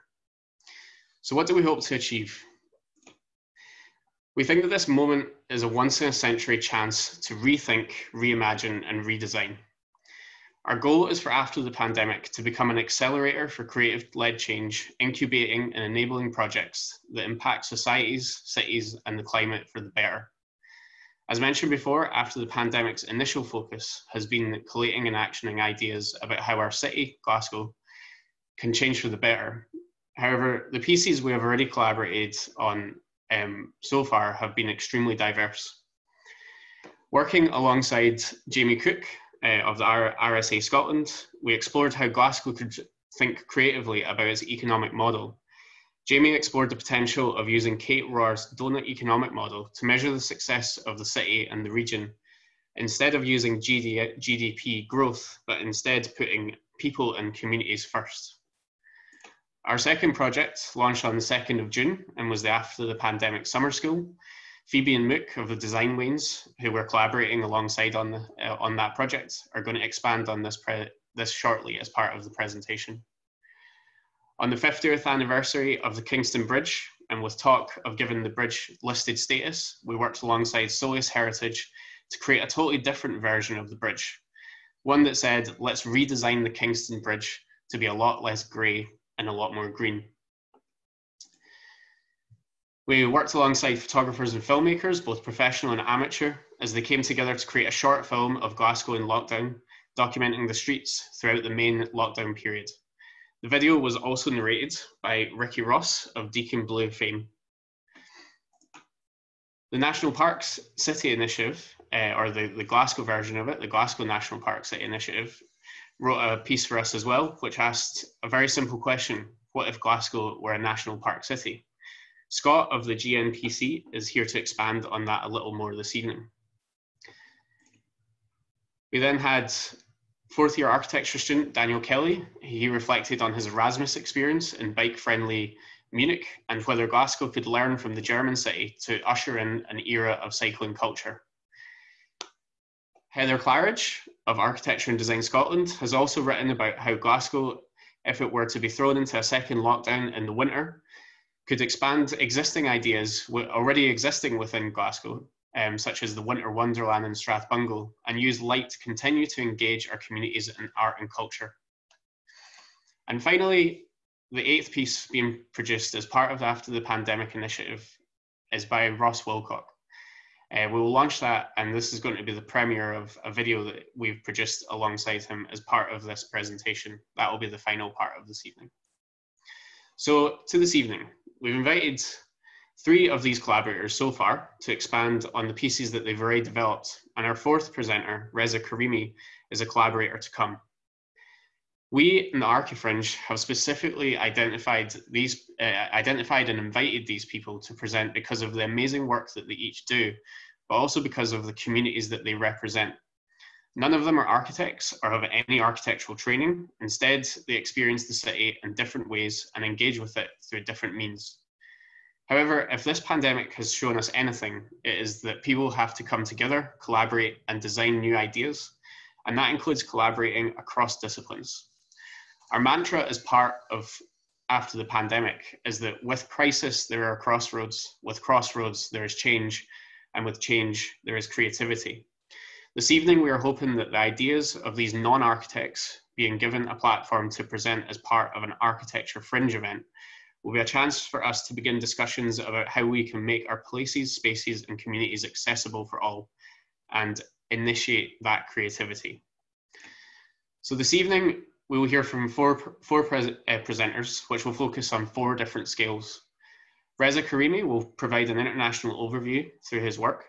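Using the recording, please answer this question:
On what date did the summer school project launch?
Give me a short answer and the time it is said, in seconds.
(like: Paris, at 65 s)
2 June, at 61 s.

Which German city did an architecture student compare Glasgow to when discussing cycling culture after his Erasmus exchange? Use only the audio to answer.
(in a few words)
Munich.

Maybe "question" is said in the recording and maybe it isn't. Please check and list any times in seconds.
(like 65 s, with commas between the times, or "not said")
118 s.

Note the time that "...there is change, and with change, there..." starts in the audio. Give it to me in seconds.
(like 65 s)
228 s.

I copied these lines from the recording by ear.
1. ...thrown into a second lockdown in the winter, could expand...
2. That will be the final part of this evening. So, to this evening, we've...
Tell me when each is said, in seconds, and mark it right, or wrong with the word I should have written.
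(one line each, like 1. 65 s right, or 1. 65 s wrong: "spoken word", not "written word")
1. 148 s right
2. 177 s right.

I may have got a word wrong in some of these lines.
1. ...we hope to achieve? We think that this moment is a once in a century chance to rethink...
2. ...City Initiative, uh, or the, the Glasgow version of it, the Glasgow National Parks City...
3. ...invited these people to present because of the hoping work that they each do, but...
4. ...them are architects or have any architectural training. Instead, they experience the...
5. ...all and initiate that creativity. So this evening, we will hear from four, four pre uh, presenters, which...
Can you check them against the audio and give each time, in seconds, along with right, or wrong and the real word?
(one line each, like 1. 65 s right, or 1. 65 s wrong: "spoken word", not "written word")
1. 1 s right
2. 110 s right
3. 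196 s wrong: "amazing", not "hoping"
4. 204 s right
5. 245 s right.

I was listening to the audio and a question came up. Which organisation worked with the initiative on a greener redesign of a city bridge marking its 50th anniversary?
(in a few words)
Solis Heritage.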